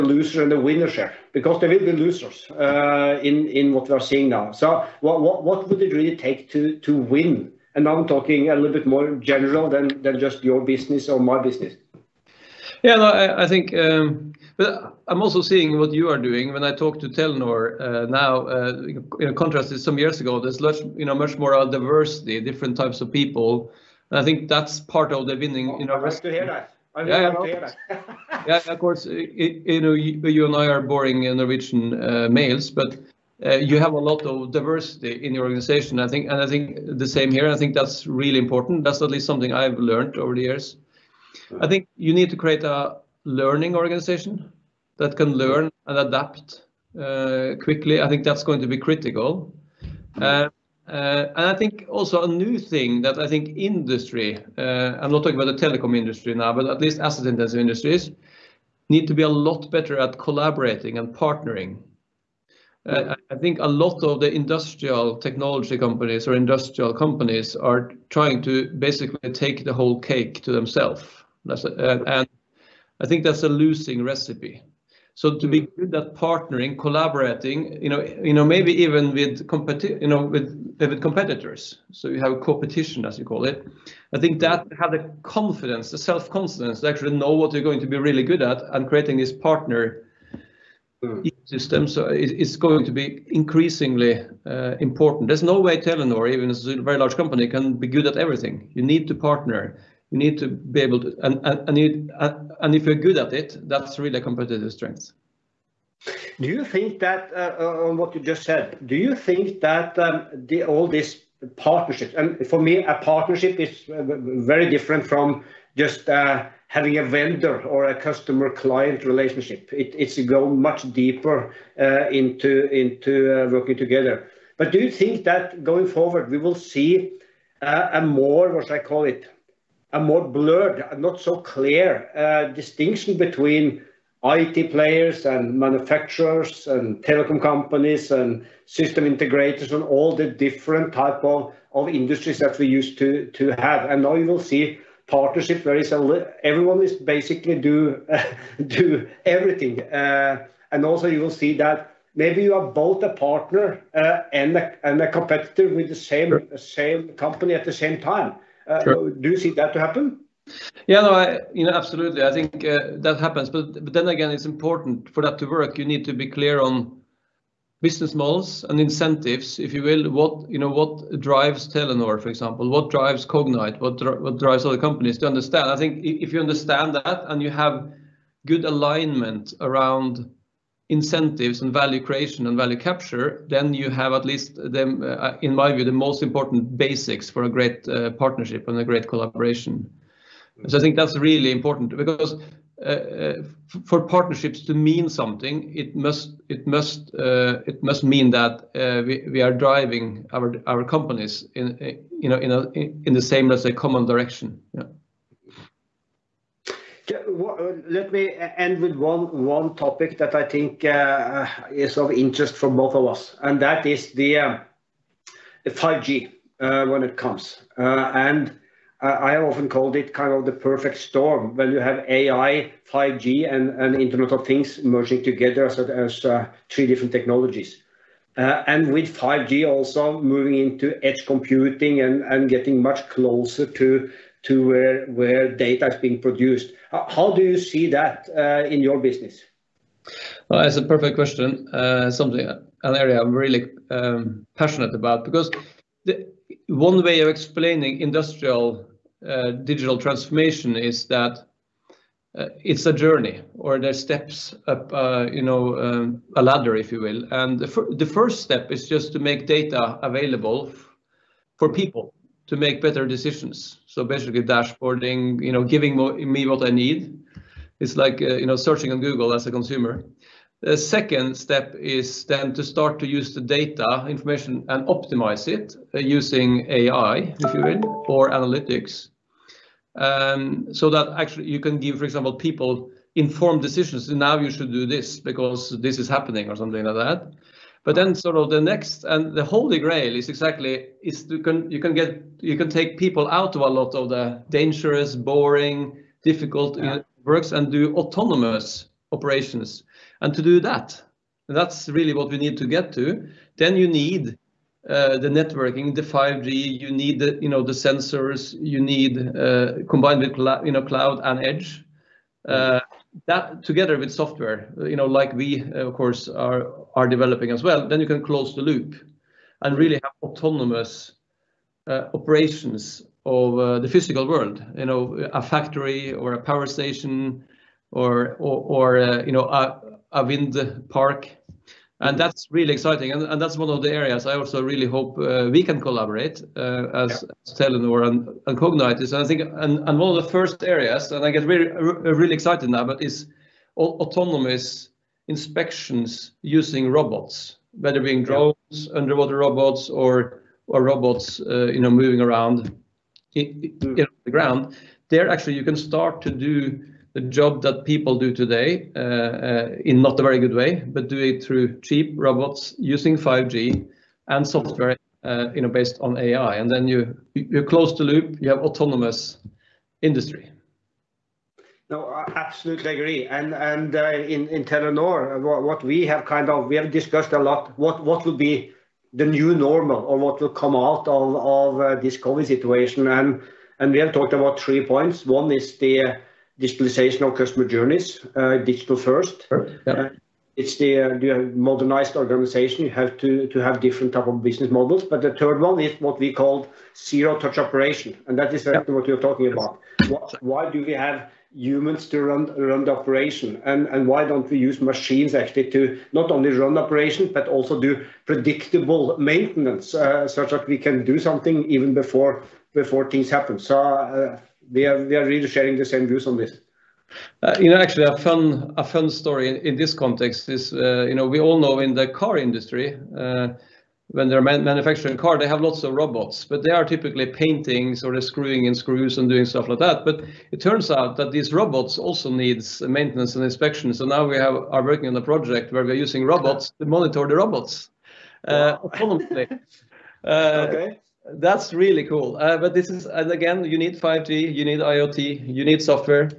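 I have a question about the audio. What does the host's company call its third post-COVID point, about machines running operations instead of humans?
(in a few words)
zero-touch operation.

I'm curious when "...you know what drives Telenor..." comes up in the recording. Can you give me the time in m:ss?
2:50.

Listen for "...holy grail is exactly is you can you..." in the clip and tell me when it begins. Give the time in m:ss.
4:49.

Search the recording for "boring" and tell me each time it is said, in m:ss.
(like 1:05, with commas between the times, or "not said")
0:30, 4:55.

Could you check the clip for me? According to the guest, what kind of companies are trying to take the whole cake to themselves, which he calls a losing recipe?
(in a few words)
industrial technology companies.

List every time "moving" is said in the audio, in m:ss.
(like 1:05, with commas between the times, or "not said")
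3:50, 5:51.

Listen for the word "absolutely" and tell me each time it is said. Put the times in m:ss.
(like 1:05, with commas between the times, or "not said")
2:41, 6:12.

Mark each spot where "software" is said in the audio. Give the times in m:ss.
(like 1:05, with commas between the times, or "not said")
5:14, 6:04, 7:25.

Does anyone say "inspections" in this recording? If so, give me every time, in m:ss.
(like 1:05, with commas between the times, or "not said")
5:45, 7:13.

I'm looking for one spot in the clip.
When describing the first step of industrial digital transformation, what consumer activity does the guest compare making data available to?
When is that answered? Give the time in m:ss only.
4:28.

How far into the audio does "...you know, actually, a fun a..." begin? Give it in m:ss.
6:57.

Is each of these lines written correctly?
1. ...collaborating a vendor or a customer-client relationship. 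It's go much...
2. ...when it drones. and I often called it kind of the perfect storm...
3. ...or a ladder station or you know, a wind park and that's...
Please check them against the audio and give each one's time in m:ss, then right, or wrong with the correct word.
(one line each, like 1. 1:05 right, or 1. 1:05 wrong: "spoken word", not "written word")
1. 1:56 wrong: "having", not "collaborating"
2. 3:36 wrong: "comes", not "drones"
3. 5:26 wrong: "power", not "ladder".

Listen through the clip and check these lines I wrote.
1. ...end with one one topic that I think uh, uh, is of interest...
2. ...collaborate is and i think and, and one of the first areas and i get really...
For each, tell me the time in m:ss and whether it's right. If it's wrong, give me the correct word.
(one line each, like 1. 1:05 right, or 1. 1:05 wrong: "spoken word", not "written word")
1. 3:28 right
2. 5:38 wrong: "cognite", not "collaborate".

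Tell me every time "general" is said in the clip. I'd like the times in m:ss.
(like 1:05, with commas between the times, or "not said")
0:09.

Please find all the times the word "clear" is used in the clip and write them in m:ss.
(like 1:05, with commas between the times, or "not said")
2:11, 2:46.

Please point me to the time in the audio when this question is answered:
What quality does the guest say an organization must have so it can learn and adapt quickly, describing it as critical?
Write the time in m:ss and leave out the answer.
0:43.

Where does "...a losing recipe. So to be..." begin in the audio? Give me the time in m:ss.
1:13.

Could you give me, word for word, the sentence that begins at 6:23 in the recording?
And and we have talked about three points.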